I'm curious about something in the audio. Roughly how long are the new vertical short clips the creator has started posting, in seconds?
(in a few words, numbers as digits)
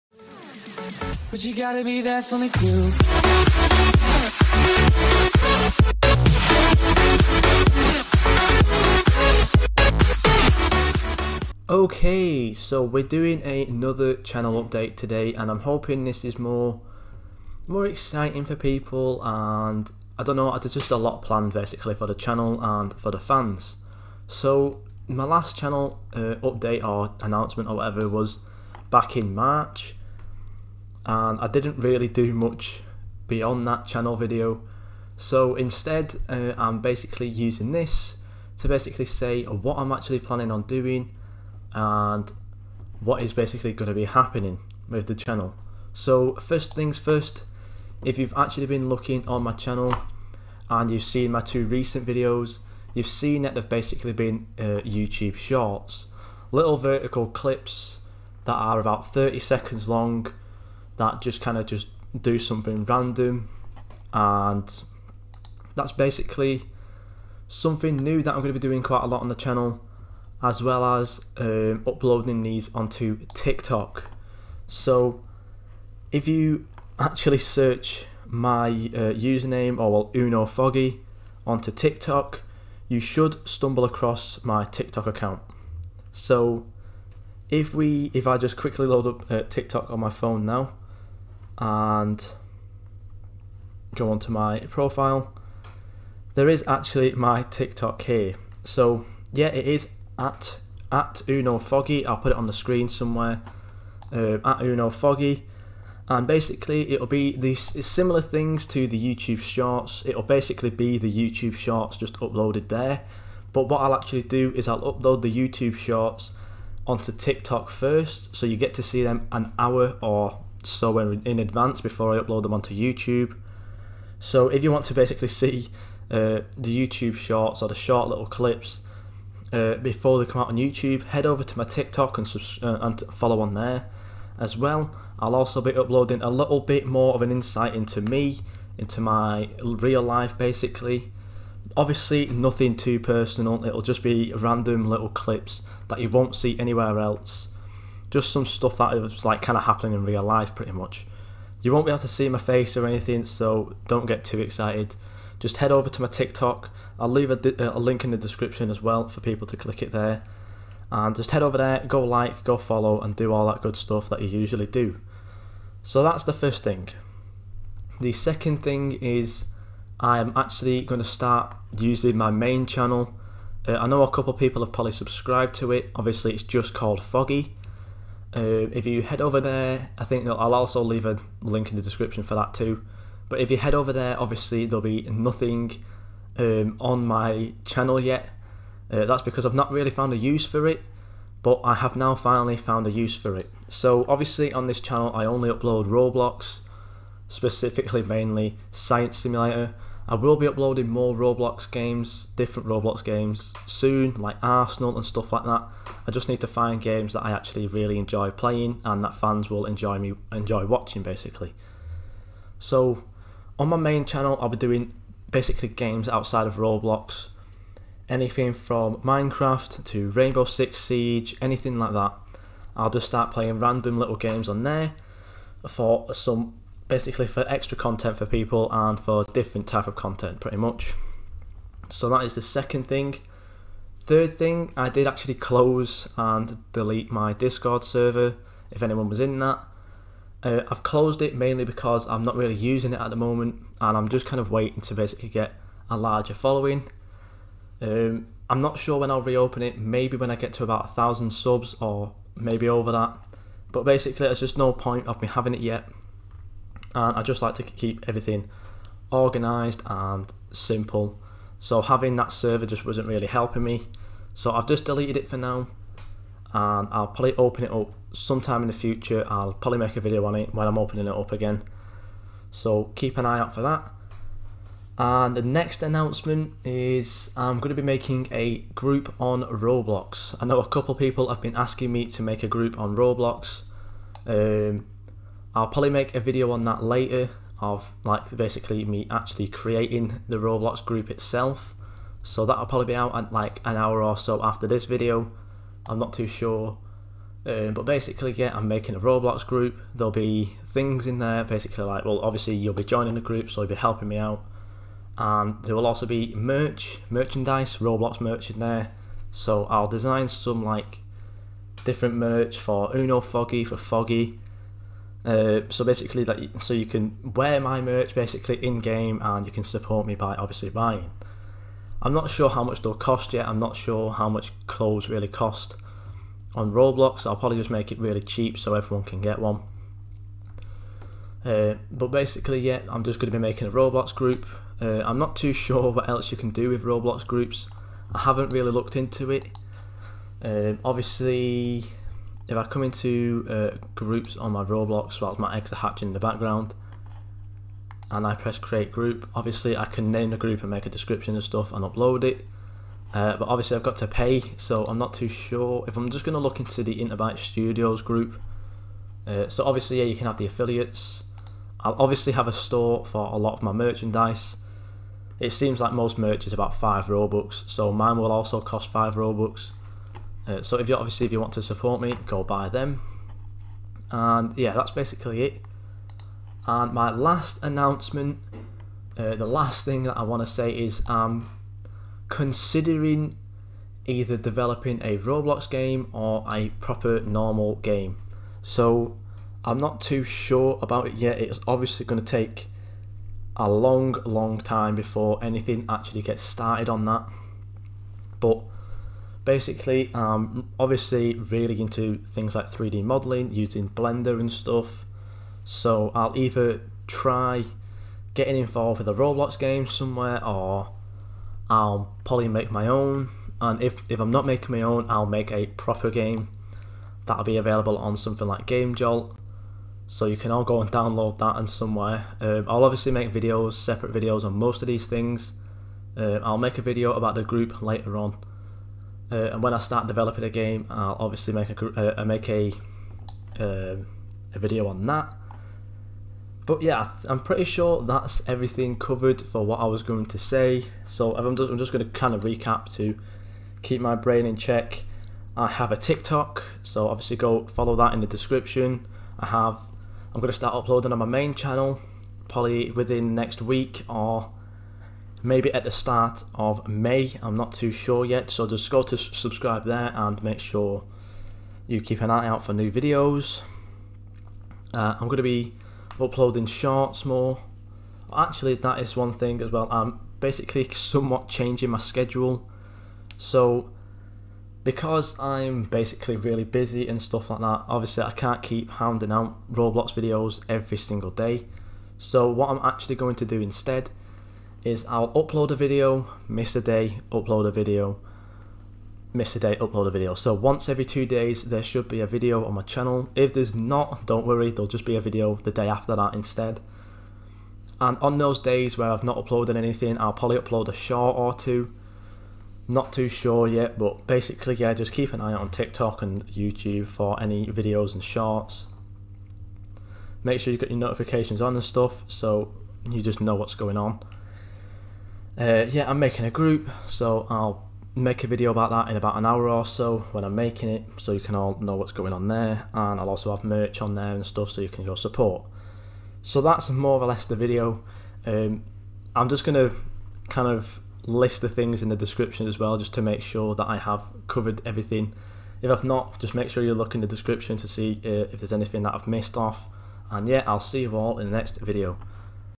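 30 seconds.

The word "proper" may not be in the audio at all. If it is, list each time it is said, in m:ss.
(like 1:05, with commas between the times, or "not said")
6:26, 6:55.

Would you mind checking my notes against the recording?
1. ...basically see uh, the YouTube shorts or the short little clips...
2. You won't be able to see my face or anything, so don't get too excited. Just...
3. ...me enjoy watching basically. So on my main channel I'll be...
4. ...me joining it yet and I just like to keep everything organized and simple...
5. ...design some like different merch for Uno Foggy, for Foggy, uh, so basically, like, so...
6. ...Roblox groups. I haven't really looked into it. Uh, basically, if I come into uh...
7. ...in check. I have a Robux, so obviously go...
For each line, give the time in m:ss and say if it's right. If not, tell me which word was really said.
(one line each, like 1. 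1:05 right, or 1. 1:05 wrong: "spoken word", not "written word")
1. 2:04 right
2. 2:31 right
3. 3:29 right
4. 4:15 wrong: "having", not "joining"
5. 5:09 right
6. 5:36 wrong: "obviously", not "basically"
7. 7:24 wrong: "TikTok", not "Robux".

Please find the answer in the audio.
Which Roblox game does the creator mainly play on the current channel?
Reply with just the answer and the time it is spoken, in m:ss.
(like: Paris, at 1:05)
Science Simulator, at 3:18.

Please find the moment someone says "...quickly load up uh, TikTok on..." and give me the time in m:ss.
1:28.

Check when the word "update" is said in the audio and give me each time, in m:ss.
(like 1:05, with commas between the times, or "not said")
0:14, 0:26.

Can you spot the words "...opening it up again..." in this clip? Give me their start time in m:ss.
4:30.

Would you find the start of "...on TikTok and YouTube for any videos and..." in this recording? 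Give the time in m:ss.
8:25.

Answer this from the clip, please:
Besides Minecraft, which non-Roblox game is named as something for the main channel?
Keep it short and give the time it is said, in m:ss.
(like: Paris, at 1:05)
Rainbow Six Siege, at 3:40.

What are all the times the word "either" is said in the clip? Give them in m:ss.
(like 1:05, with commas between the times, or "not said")
6:24, 6:46.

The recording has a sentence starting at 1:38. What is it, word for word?
So yeah, it is at at Uno Foggy.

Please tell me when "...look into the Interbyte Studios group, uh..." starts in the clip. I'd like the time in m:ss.
5:56.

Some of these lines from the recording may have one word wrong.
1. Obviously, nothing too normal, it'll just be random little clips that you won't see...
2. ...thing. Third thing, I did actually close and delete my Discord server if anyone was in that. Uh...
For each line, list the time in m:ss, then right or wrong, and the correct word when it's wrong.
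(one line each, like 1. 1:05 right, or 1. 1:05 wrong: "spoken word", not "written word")
1. 2:21 wrong: "personal", not "normal"
2. 3:52 right.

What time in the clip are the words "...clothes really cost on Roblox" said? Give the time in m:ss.
5:24.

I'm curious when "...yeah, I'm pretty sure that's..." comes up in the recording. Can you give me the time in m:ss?
7:16.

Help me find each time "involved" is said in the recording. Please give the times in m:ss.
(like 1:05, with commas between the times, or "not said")
6:48.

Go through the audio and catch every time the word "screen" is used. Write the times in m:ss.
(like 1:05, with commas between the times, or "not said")
1:42.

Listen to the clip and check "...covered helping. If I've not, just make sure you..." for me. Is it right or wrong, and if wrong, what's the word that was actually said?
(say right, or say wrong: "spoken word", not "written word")
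wrong: "everything", not "helping".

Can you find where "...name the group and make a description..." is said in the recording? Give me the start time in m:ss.
5:50.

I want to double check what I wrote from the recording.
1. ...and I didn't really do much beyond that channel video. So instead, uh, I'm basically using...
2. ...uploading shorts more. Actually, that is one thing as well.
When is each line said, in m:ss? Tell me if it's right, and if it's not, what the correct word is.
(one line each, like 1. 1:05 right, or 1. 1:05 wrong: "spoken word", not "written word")
1. 0:31 right
2. 7:46 right.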